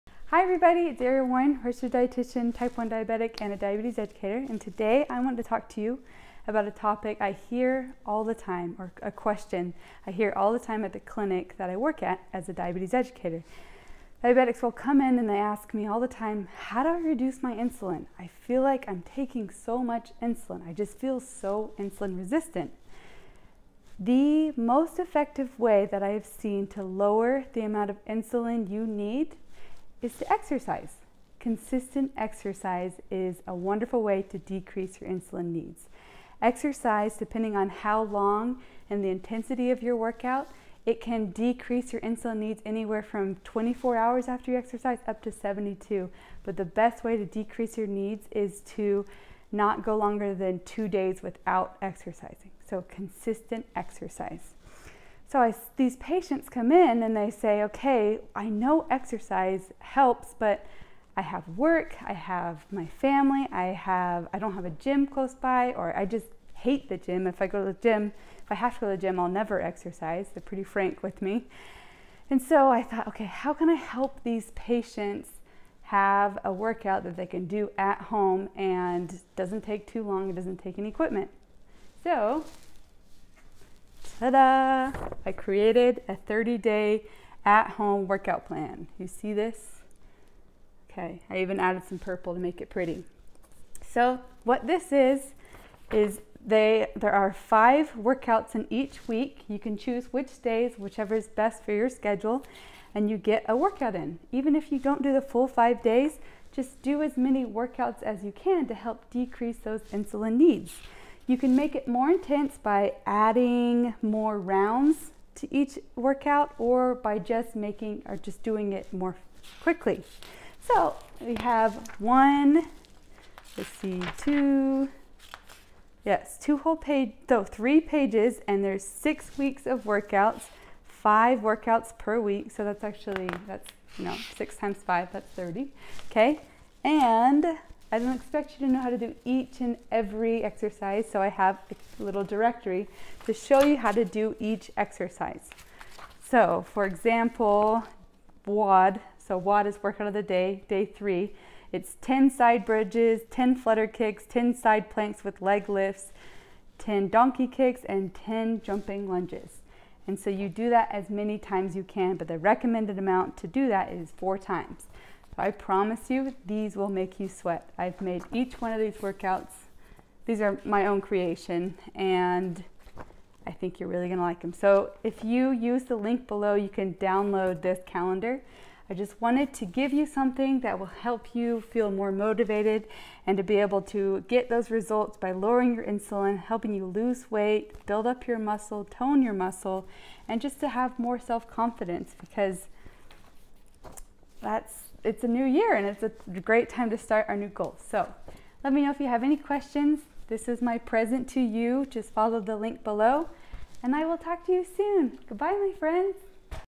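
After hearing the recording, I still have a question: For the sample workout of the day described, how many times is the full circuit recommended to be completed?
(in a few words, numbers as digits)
4.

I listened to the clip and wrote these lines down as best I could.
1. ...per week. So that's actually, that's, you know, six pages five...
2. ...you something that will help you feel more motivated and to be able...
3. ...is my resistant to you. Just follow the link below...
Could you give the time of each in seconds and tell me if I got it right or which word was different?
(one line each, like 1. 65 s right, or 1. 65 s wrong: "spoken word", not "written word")
1. 131 s wrong: "times", not "pages"
2. 179 s right
3. 200 s wrong: "present", not "resistant".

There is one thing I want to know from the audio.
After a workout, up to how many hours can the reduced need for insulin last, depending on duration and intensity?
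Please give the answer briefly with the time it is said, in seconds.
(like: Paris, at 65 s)
72, at 45 s.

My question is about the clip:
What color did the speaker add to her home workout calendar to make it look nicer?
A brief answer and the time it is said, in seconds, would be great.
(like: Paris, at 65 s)
purple, at 91 s.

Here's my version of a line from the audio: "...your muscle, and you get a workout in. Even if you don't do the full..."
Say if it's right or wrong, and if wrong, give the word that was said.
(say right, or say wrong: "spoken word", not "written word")
wrong: "schedule", not "muscle".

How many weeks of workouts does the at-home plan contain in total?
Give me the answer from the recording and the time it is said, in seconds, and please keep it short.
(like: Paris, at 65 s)
6, at 128 s.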